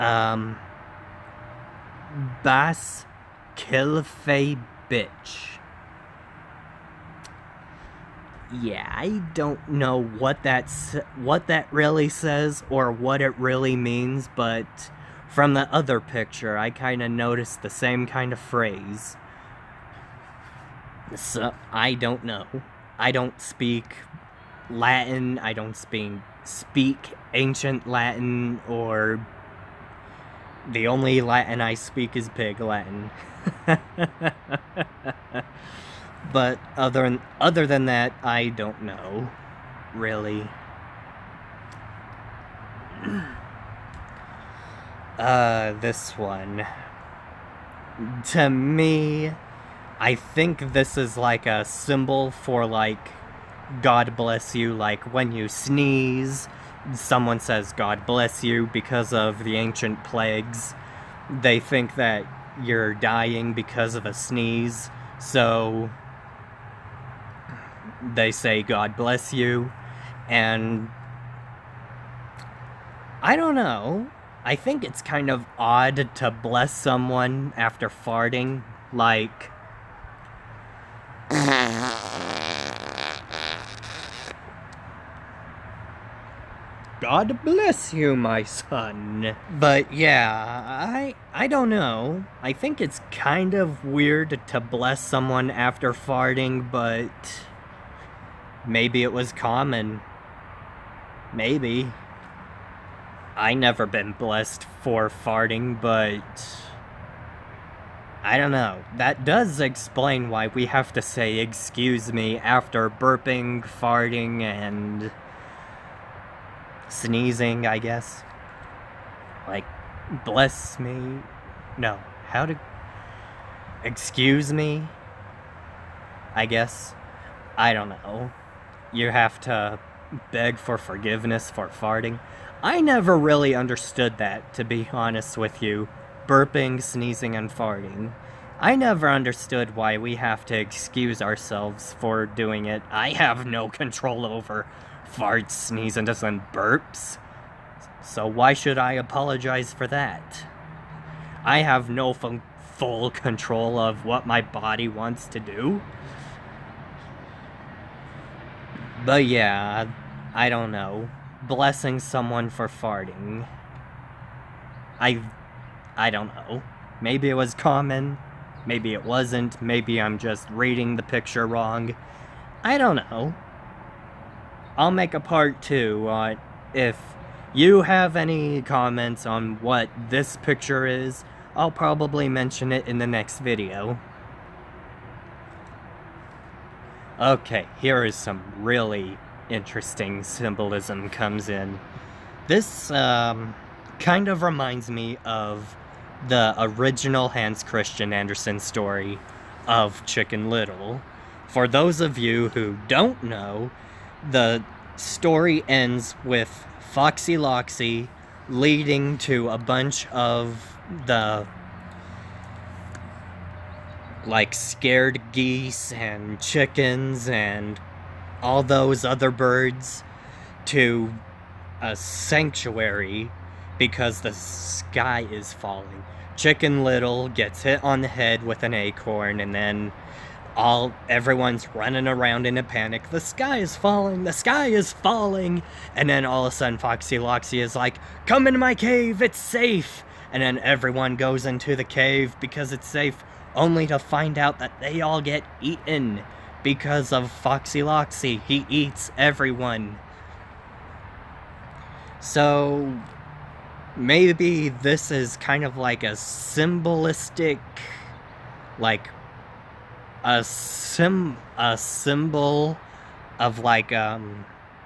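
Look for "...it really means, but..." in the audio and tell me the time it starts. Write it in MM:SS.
00:13.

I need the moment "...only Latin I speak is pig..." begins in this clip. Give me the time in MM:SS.
00:30.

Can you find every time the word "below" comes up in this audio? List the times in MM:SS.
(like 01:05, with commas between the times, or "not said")
not said.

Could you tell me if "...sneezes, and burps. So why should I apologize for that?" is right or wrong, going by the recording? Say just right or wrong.
right.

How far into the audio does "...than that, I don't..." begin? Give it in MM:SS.
00:37.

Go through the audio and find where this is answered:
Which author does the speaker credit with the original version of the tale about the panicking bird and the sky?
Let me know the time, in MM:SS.
03:17.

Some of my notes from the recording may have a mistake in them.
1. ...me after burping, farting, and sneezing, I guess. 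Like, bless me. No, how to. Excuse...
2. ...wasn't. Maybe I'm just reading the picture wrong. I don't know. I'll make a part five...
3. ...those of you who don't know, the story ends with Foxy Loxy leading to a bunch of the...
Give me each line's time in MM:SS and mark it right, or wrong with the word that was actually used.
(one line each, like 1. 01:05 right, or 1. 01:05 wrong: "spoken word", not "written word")
1. 01:52 right
2. 02:49 wrong: "two", not "five"
3. 03:21 right.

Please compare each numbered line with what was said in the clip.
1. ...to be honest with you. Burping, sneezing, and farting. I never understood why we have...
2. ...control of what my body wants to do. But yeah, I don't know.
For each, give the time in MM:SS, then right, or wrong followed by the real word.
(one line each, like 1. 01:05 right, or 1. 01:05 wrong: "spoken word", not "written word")
1. 02:14 right
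2. 02:33 right.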